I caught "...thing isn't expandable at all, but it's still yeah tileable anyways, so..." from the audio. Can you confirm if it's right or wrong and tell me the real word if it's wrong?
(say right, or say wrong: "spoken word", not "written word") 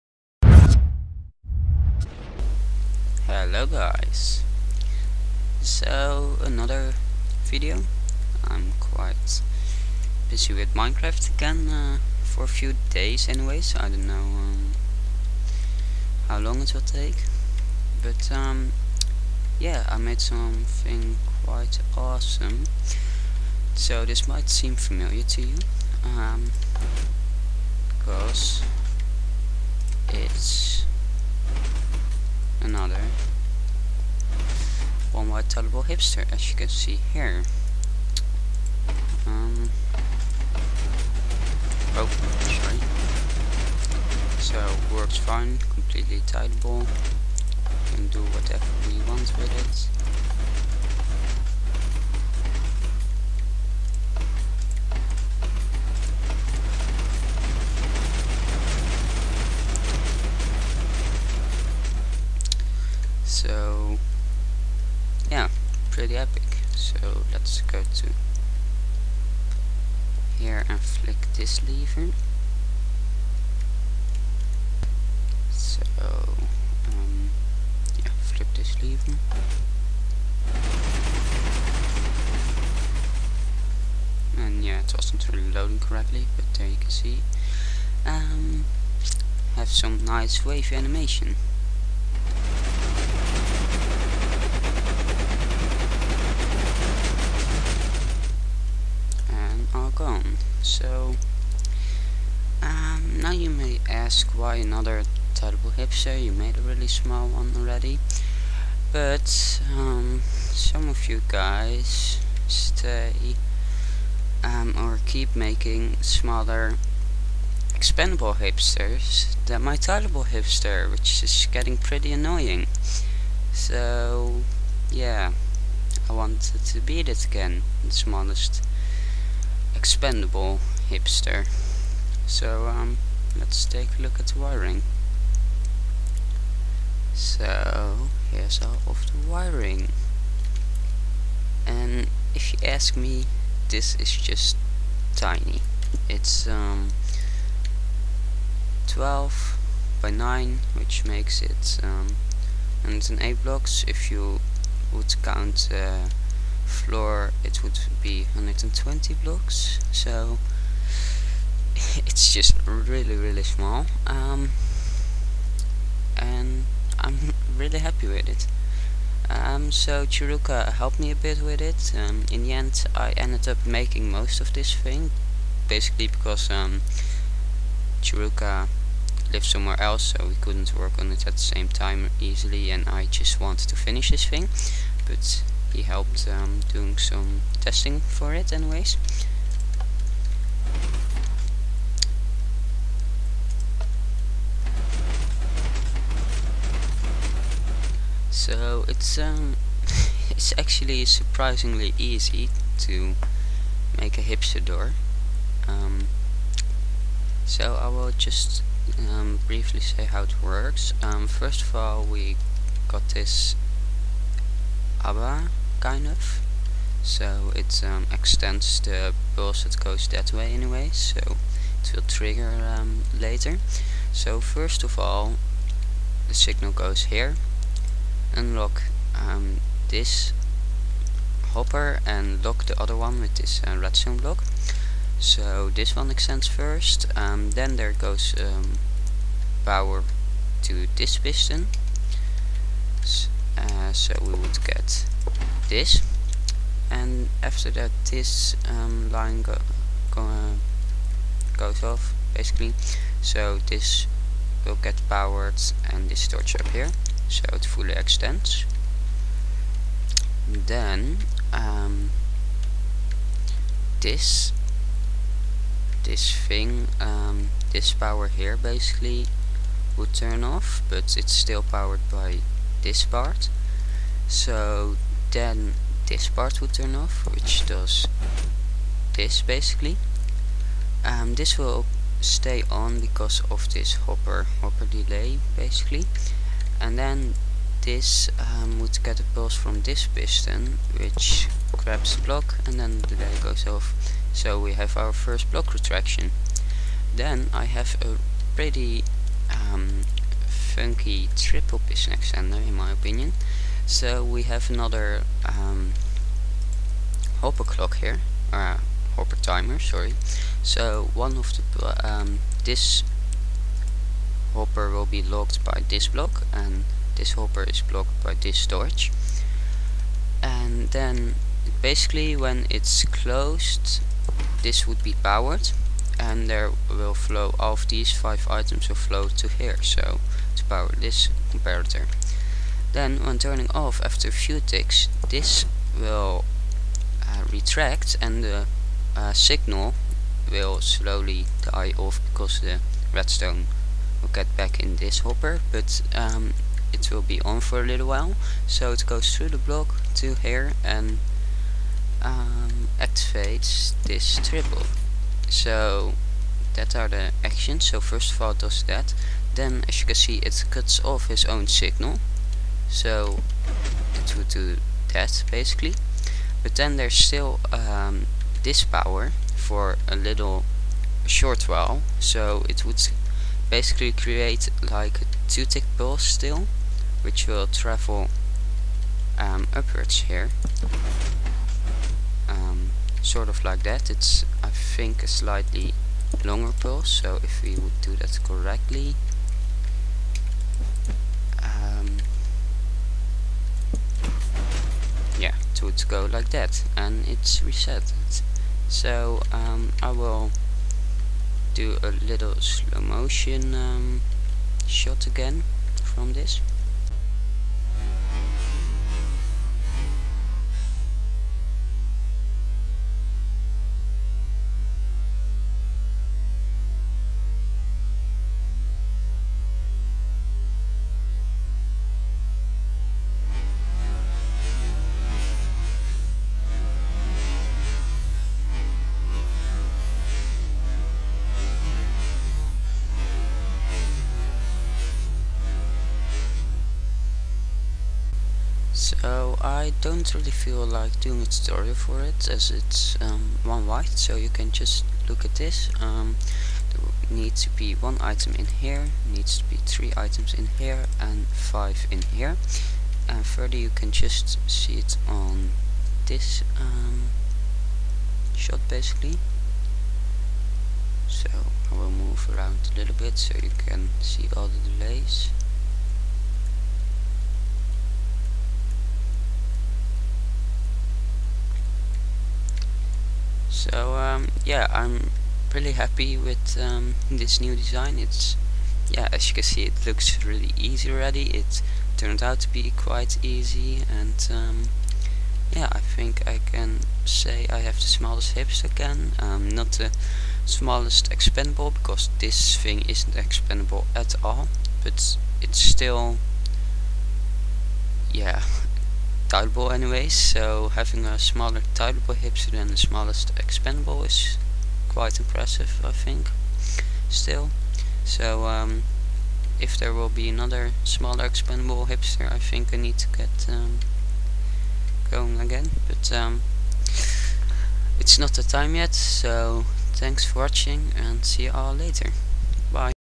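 right.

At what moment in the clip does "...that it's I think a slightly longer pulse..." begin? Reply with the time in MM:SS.
06:23.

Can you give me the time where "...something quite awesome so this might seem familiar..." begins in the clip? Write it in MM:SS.
00:20.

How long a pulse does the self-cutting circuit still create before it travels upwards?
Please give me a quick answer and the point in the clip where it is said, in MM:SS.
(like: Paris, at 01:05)
2 tick, at 06:15.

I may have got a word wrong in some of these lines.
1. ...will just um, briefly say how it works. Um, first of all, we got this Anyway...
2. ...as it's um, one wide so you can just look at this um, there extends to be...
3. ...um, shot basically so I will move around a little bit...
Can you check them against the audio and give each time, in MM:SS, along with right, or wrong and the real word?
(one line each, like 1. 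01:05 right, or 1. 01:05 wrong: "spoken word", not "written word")
1. 03:27 wrong: "ABBA", not "Anyway"
2. 07:22 wrong: "needs", not "extends"
3. 07:36 right.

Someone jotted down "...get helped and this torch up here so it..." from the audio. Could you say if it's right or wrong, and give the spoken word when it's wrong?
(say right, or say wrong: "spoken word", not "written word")
wrong: "powered", not "helped".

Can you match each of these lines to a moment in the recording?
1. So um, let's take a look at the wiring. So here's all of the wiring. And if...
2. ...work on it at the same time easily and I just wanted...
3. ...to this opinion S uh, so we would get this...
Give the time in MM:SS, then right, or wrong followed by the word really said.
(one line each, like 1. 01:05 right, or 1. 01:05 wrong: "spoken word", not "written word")
1. 02:12 right
2. 03:00 right
3. 04:00 wrong: "piston", not "opinion".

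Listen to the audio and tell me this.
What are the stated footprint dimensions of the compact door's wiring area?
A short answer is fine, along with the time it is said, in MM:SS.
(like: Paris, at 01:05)
12 by 9, at 02:28.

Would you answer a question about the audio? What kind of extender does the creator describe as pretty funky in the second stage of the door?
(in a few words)
triple piston extender.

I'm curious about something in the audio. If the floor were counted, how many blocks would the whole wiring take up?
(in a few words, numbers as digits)
120.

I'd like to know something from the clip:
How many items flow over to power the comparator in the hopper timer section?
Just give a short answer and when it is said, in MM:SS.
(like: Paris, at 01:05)
5, at 05:28.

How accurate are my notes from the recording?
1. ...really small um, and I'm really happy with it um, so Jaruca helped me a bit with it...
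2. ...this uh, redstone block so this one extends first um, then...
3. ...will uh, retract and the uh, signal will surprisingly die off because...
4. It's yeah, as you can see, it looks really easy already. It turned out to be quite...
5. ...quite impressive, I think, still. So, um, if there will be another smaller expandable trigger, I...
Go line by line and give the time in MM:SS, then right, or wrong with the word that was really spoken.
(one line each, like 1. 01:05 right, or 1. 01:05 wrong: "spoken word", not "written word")
1. 02:43 right
2. 03:53 right
3. 05:35 wrong: "slowly", not "surprisingly"
4. 07:58 right
5. 08:25 wrong: "hipster", not "trigger".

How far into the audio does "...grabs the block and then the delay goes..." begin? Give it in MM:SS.
04:51.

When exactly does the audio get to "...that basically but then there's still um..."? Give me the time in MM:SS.
06:05.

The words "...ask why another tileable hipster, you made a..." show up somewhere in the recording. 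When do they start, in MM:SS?
01:43.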